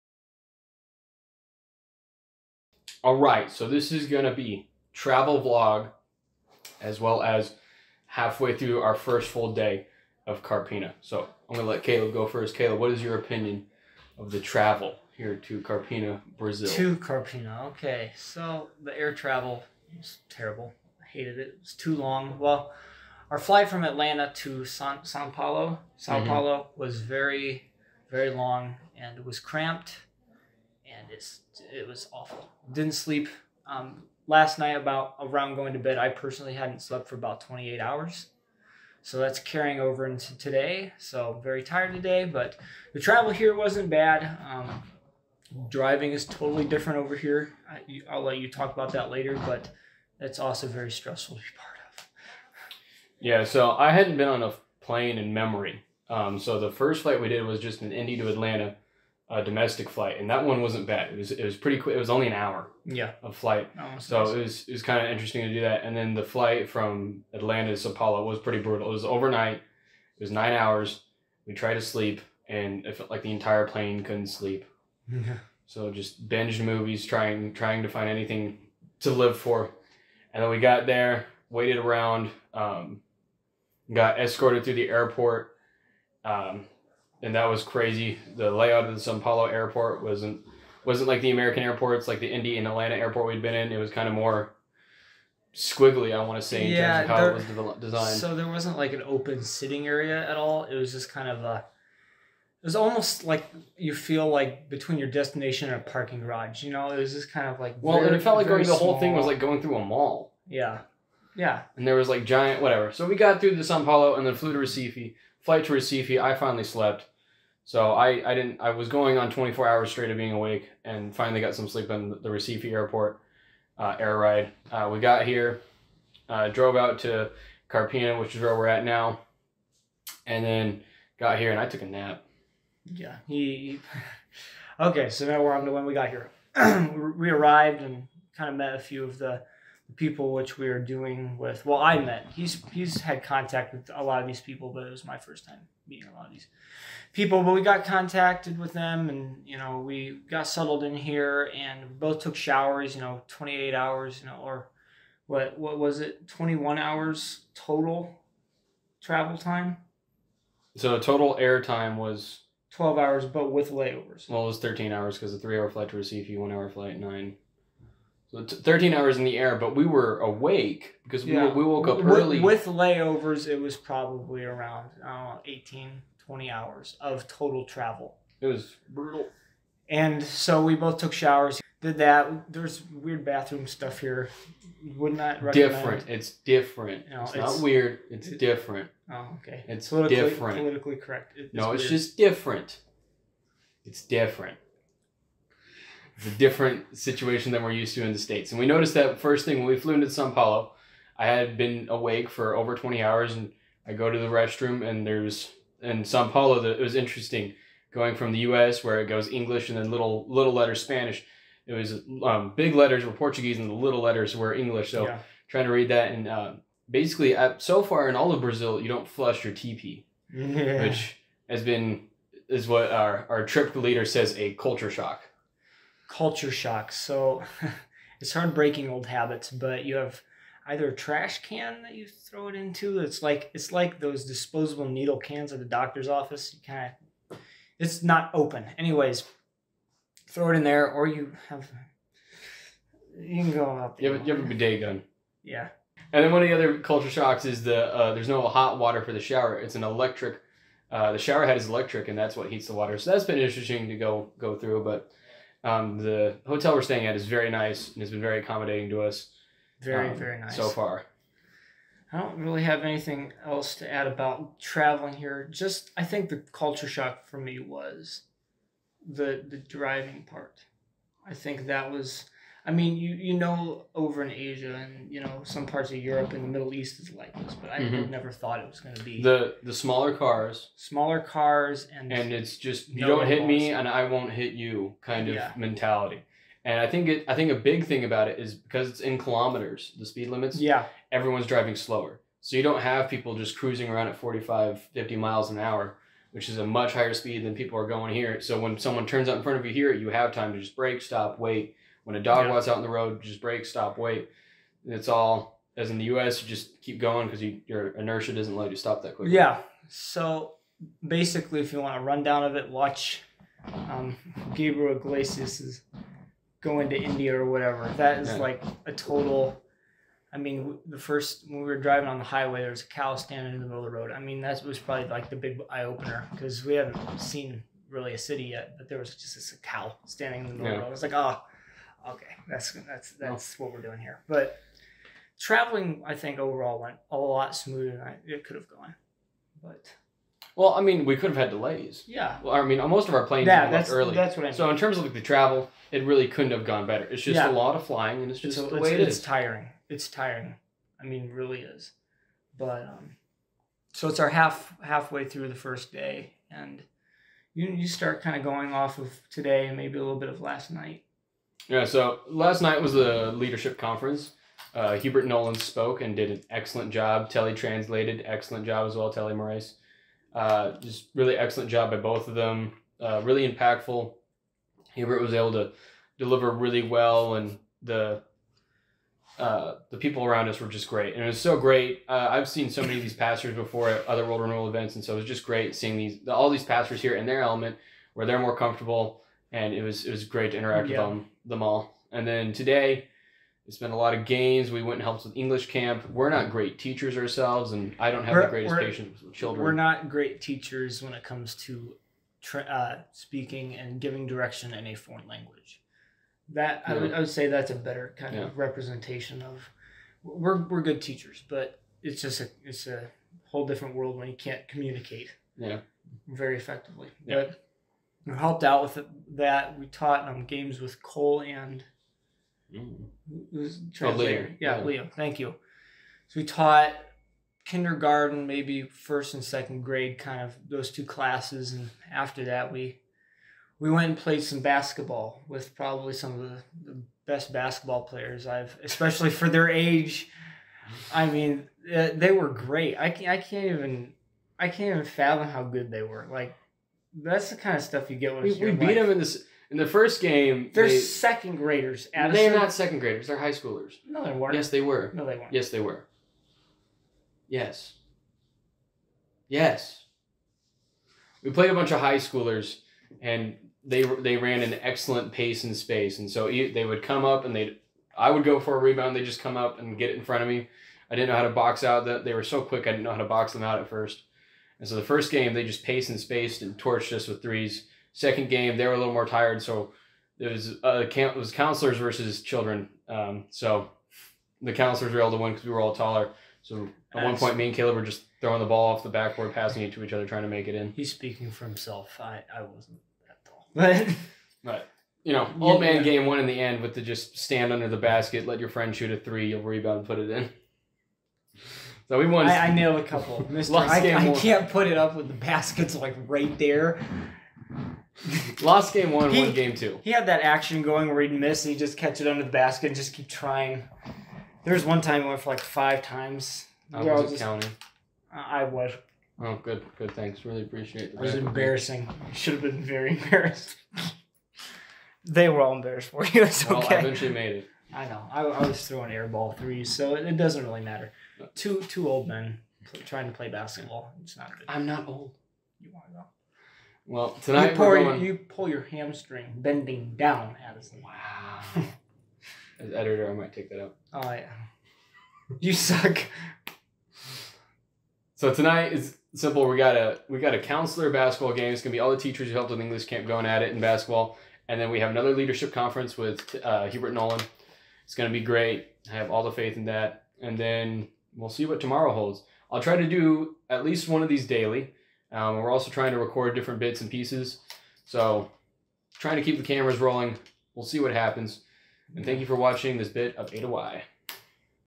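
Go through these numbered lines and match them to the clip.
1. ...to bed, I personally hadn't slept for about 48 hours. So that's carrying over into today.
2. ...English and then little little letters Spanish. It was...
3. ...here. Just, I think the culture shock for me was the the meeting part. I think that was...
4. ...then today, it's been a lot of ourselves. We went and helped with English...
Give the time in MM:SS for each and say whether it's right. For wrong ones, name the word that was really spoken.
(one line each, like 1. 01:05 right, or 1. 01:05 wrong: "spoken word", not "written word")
1. 00:35 wrong: "28", not "48"
2. 03:29 right
3. 04:25 wrong: "driving", not "meeting"
4. 06:32 wrong: "games", not "ourselves".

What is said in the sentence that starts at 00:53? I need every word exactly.
Yeah, so I hadn't been on a plane in memory.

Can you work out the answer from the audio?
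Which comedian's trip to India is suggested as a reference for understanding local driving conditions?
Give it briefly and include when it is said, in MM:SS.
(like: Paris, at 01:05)
Gabriel Iglesias, at 05:14.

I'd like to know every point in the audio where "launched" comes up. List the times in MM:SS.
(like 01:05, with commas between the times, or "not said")
not said.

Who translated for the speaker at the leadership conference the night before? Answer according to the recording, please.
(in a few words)
Telly Moraes.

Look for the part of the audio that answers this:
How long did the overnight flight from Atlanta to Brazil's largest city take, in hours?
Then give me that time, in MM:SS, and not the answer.
01:10.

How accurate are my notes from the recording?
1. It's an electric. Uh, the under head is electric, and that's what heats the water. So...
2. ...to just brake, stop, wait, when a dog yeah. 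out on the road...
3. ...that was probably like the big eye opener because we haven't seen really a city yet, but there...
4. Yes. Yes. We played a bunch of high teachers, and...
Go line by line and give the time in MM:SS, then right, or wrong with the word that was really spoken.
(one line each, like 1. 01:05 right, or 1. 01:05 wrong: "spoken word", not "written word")
1. 04:09 wrong: "shower", not "under"
2. 05:00 right
3. 05:24 right
4. 07:37 wrong: "schoolers", not "teachers".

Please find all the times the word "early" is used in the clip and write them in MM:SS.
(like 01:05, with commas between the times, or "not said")
02:52, 05:43.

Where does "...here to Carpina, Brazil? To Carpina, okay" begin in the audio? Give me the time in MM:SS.
00:15.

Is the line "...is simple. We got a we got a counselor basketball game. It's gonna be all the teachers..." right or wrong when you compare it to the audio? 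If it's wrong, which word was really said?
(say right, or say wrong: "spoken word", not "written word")
right.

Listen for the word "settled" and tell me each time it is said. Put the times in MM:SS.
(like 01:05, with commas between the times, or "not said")
02:30.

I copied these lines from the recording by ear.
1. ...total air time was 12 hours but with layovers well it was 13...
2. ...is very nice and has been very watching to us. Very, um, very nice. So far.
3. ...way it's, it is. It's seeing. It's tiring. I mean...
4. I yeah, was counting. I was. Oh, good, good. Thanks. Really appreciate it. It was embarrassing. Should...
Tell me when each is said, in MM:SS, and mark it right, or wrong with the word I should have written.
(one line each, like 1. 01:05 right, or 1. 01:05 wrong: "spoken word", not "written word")
1. 02:40 right
2. 04:17 wrong: "accommodating", not "watching"
3. 05:48 wrong: "tiring", not "seeing"
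4. 08:36 right.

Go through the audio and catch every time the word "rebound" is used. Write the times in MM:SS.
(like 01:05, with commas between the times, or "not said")
07:48, 08:19.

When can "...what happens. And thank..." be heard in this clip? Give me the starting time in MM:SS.
09:30.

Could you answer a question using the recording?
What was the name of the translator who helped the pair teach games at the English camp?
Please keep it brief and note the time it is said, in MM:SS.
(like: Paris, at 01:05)
Leo, at 07:04.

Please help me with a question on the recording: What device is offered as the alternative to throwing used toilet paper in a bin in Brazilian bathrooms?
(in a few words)
Bidet gun.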